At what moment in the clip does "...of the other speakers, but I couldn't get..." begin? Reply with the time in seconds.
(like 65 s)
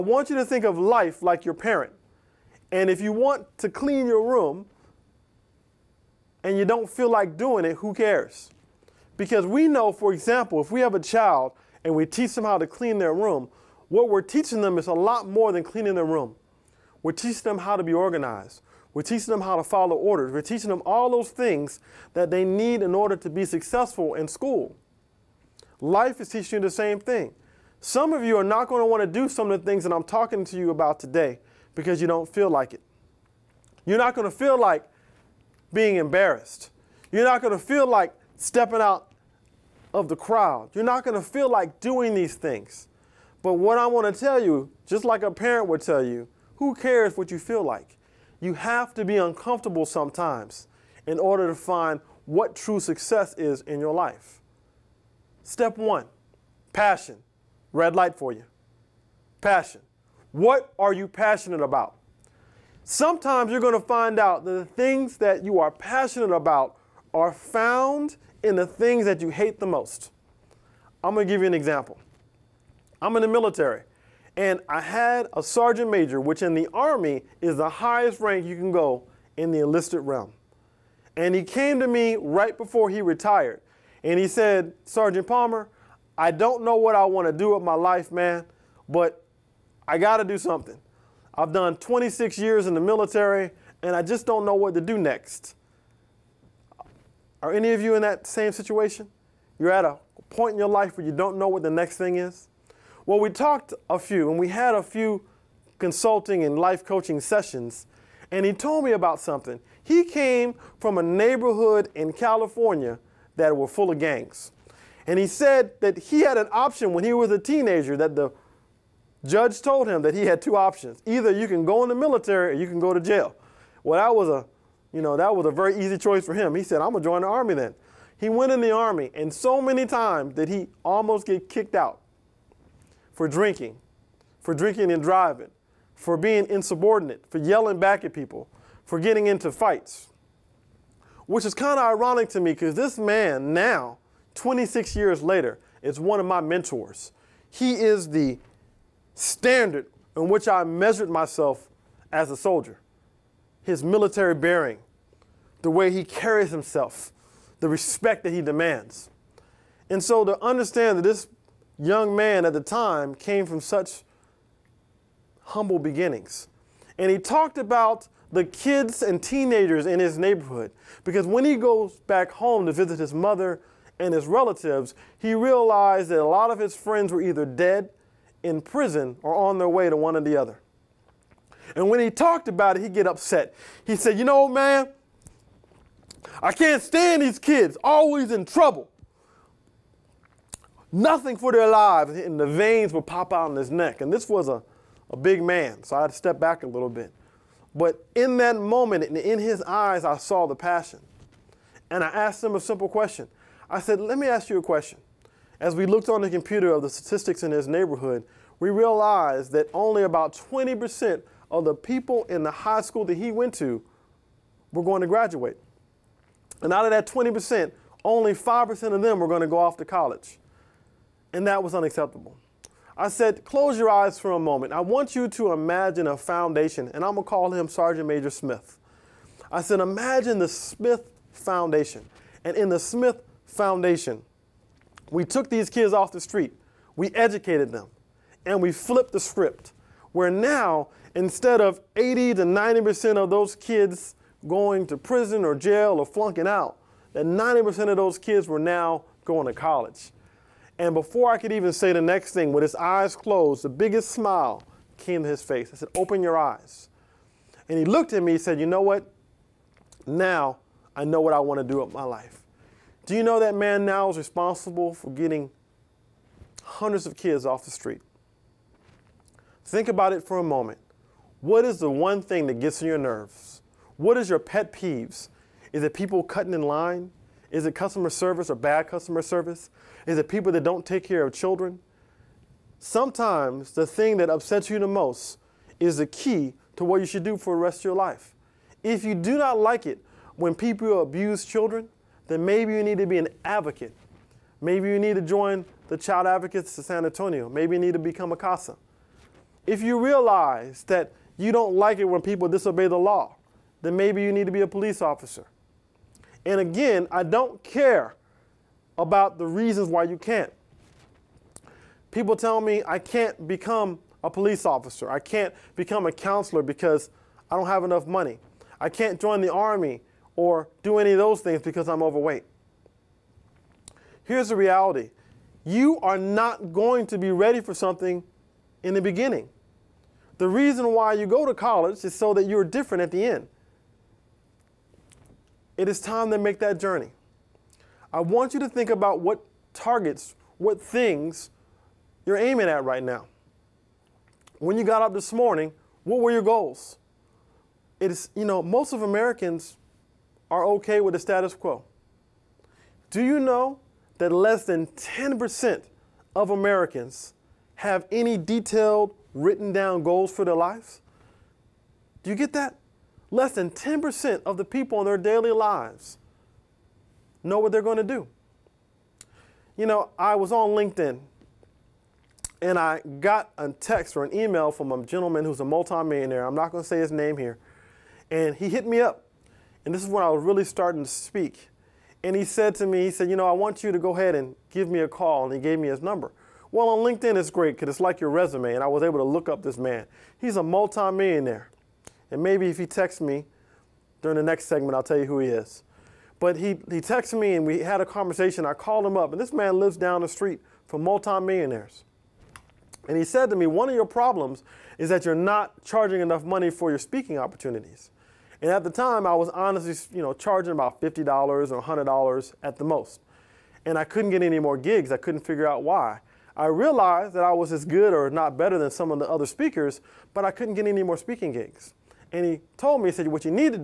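419 s.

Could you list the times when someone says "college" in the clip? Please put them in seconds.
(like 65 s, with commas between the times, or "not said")
219 s, 249 s, 331 s.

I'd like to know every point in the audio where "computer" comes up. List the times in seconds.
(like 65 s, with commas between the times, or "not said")
206 s.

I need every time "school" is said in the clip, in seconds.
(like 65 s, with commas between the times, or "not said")
24 s, 212 s.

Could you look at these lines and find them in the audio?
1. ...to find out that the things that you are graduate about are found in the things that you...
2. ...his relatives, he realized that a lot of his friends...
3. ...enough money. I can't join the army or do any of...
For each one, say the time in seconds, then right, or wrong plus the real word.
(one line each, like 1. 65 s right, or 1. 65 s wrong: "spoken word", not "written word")
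1. 63 s wrong: "passionate", not "graduate"
2. 174 s right
3. 317 s right.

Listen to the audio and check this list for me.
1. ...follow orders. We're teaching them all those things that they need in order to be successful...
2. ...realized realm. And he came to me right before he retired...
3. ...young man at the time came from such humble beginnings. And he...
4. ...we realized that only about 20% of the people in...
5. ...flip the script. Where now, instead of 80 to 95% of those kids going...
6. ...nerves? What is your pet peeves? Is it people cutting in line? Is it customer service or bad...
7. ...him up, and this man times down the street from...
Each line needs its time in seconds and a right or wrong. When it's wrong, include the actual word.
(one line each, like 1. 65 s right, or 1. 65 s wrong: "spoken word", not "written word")
1. 19 s right
2. 79 s wrong: "enlisted", not "realized"
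3. 161 s right
4. 208 s right
5. 238 s wrong: "90", not "95"
6. 272 s right
7. 399 s wrong: "lives", not "times".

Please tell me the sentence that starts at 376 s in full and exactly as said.
I'm not going to say his name here.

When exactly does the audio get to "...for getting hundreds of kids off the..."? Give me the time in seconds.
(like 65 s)
264 s.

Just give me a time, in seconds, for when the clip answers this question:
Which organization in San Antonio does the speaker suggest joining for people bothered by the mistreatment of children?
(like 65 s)
295 s.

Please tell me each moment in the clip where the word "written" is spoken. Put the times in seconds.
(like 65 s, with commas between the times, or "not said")
359 s.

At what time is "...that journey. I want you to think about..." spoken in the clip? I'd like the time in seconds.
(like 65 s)
336 s.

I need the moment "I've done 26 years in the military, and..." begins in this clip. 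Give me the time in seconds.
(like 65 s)
91 s.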